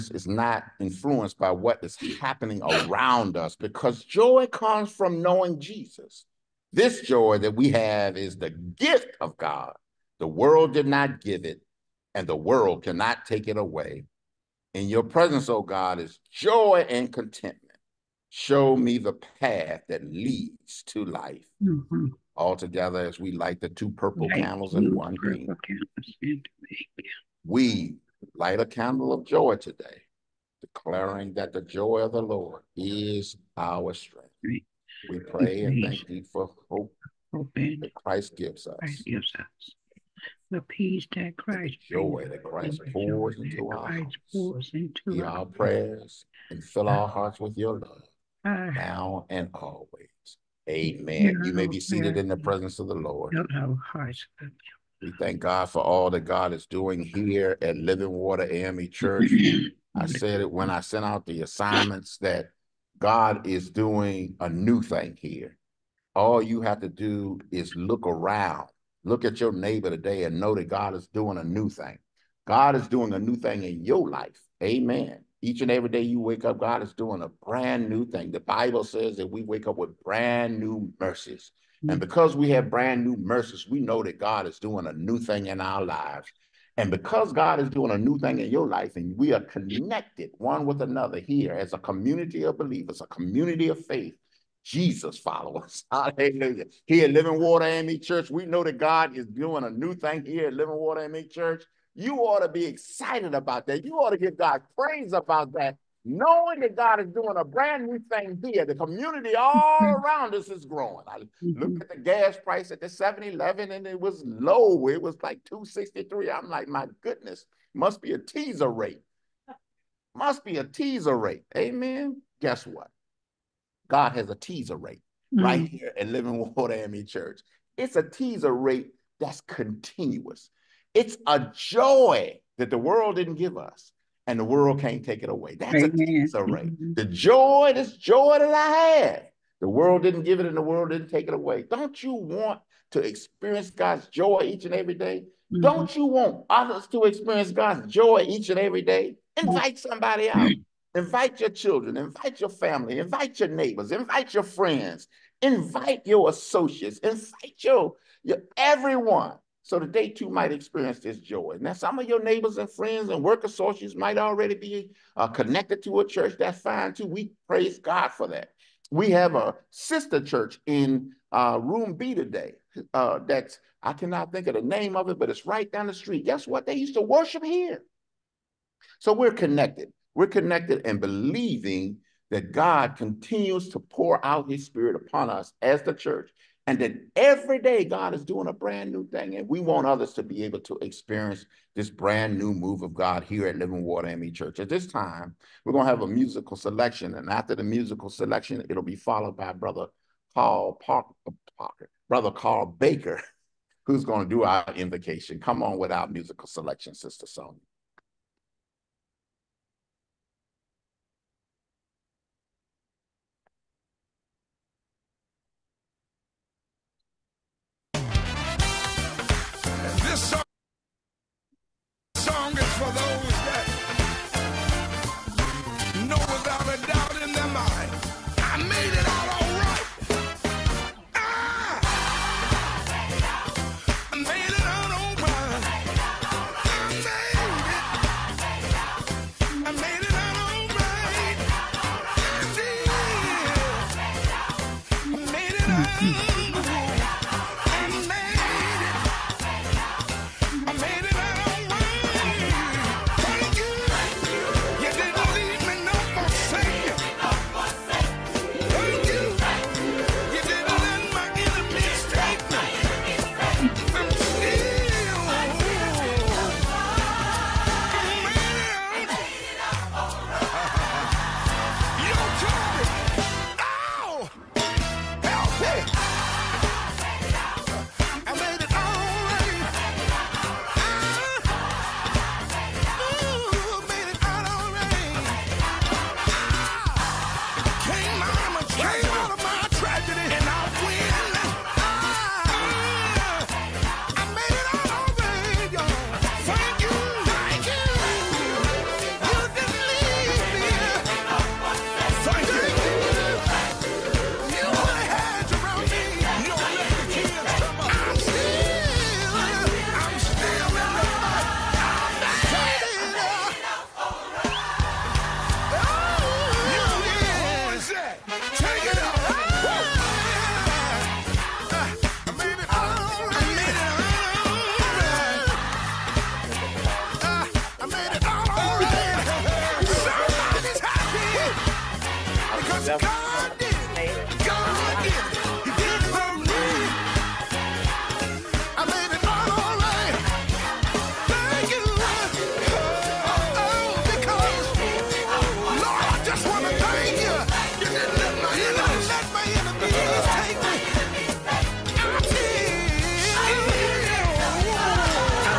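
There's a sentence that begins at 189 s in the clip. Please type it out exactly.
And we want others to be able to experience this brand new move of God here at Living Water AME Church.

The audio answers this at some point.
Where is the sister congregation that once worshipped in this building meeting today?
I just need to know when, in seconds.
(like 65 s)
171 s.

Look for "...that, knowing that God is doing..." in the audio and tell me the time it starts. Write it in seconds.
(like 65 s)
105 s.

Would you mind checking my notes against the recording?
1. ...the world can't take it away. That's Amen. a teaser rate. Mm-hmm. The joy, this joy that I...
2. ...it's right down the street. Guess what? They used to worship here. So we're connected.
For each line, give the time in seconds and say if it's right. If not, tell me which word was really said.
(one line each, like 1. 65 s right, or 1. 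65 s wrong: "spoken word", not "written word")
1. 134 s right
2. 175 s right.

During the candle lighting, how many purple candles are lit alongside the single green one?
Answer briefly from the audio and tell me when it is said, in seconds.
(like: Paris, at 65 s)
2, at 23 s.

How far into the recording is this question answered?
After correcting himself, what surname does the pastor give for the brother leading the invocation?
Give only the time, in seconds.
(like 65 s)
202 s.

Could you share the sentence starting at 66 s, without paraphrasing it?
All you have to do is look around Look at your neighbor today and know that God is doing a new thing.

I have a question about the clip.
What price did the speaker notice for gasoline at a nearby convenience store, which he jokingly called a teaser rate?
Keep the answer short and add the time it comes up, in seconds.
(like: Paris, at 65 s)
263, at 115 s.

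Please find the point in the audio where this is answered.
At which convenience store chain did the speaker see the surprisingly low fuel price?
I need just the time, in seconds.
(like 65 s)
112 s.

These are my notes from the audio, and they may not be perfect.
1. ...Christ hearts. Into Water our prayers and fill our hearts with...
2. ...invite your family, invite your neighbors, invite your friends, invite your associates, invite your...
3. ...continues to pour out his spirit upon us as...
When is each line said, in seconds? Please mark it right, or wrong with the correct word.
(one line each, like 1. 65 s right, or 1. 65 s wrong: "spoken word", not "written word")
1. 43 s wrong: "Hear", not "Water"
2. 151 s right
3. 182 s right.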